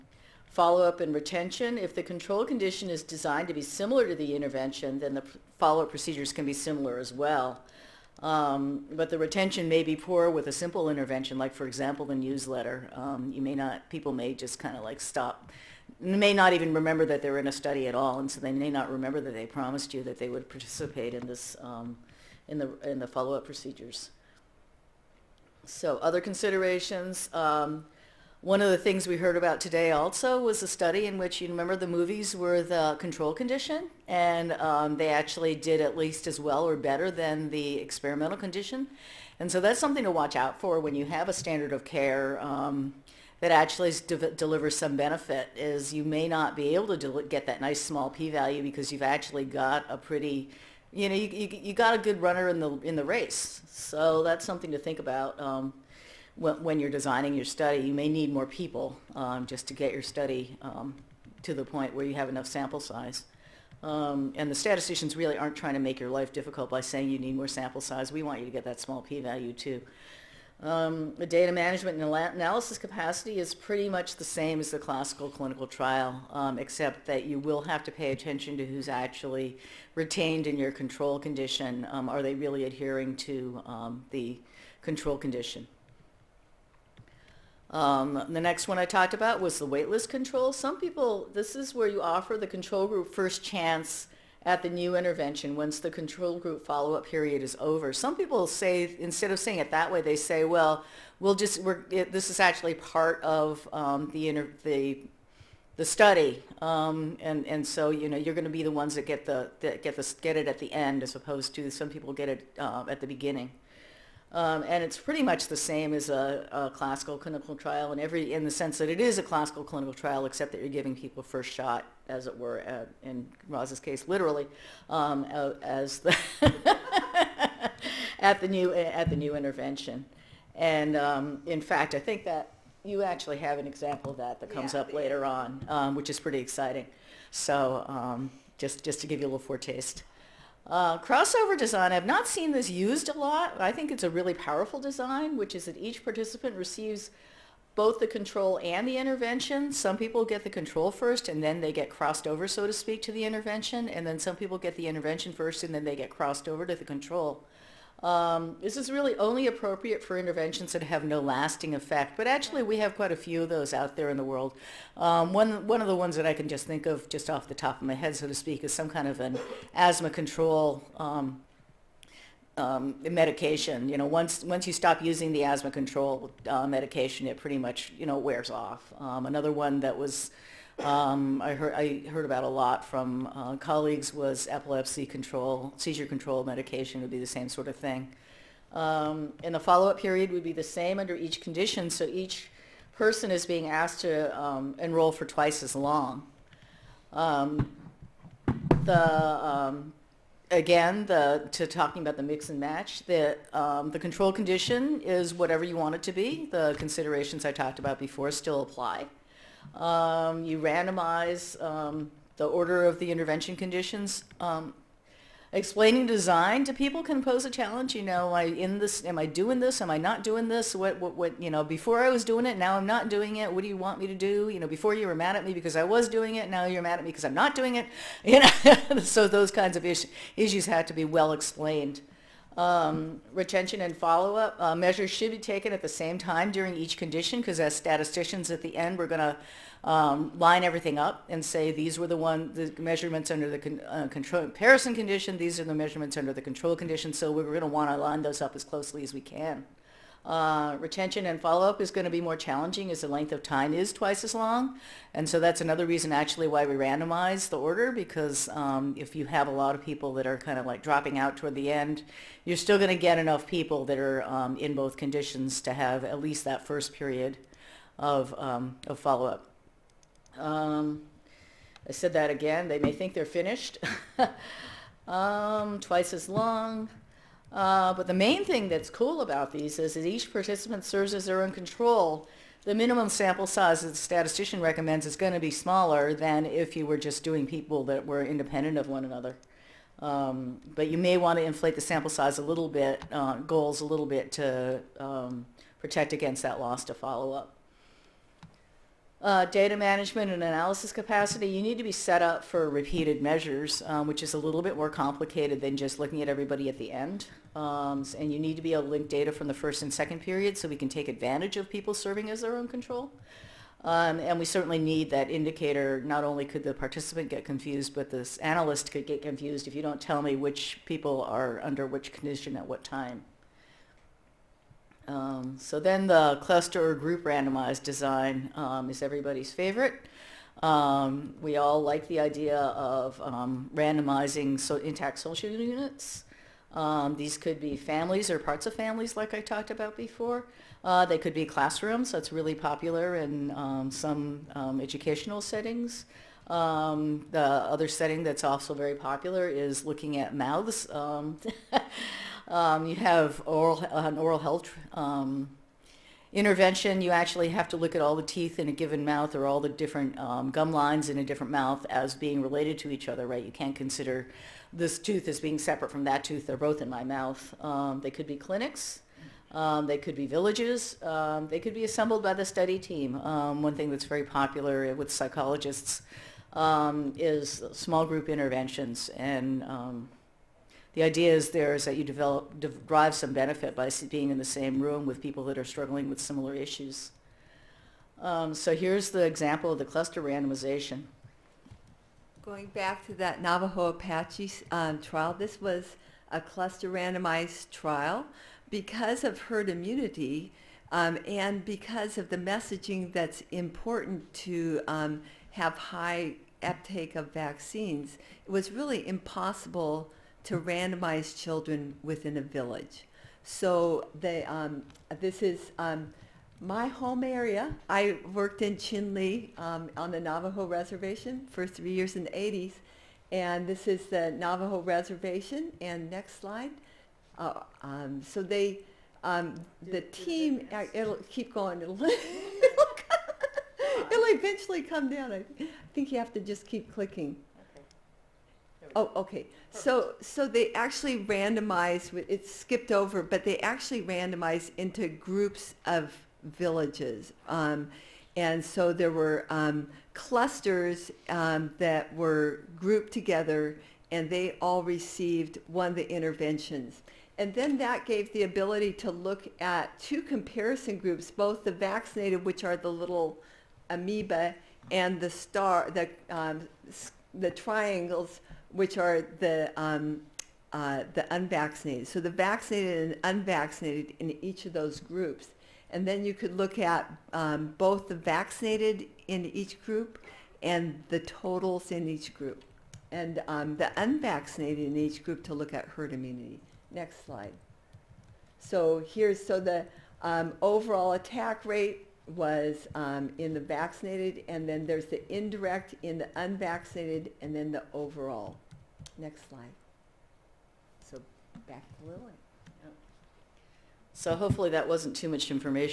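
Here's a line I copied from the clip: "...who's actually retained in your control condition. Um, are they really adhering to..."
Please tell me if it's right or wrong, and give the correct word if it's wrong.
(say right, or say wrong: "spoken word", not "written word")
right.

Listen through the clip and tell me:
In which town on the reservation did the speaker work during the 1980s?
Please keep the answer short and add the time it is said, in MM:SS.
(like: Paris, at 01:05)
Chinle, at 06:58.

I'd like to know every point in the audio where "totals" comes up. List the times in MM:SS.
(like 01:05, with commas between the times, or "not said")
08:01.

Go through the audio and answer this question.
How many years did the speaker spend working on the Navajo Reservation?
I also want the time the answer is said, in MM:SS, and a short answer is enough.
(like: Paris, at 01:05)
3, at 07:01.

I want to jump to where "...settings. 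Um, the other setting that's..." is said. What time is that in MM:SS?
05:45.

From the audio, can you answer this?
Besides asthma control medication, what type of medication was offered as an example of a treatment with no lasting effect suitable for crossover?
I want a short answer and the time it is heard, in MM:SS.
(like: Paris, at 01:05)
Seizure control medication, at 03:05.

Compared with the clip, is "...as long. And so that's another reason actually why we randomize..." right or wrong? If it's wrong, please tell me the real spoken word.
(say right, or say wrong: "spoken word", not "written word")
right.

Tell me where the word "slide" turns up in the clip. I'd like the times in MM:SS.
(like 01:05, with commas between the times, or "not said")
07:06, 08:07, 08:19.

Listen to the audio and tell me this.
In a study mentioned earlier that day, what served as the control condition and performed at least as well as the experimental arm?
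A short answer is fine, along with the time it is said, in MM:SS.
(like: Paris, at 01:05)
Movies, at 00:31.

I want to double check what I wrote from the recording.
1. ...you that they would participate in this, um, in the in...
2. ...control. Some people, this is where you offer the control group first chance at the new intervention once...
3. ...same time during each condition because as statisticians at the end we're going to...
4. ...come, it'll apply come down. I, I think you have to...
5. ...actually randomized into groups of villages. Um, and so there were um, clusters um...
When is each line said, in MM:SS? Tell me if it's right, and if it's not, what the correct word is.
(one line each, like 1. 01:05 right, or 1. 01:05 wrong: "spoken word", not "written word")
1. 00:19 right
2. 01:30 right
3. 03:55 right
4. 07:12 wrong: "eventually", not "apply"
5. 07:23 right.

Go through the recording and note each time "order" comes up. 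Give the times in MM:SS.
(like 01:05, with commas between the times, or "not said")
03:32, 04:17.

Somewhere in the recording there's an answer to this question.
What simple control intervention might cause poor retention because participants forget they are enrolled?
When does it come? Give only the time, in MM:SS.
00:12.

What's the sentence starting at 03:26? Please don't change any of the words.
The considerations I talked about before still apply.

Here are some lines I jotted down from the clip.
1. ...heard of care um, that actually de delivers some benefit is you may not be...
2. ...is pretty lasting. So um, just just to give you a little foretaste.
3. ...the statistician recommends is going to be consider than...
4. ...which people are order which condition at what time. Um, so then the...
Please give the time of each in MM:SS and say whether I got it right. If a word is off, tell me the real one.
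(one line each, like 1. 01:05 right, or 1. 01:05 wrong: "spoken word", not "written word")
1. 00:41 wrong: "standard", not "heard"
2. 02:16 wrong: "exciting", not "lasting"
3. 04:43 wrong: "smaller", not "consider"
4. 05:20 wrong: "under", not "order".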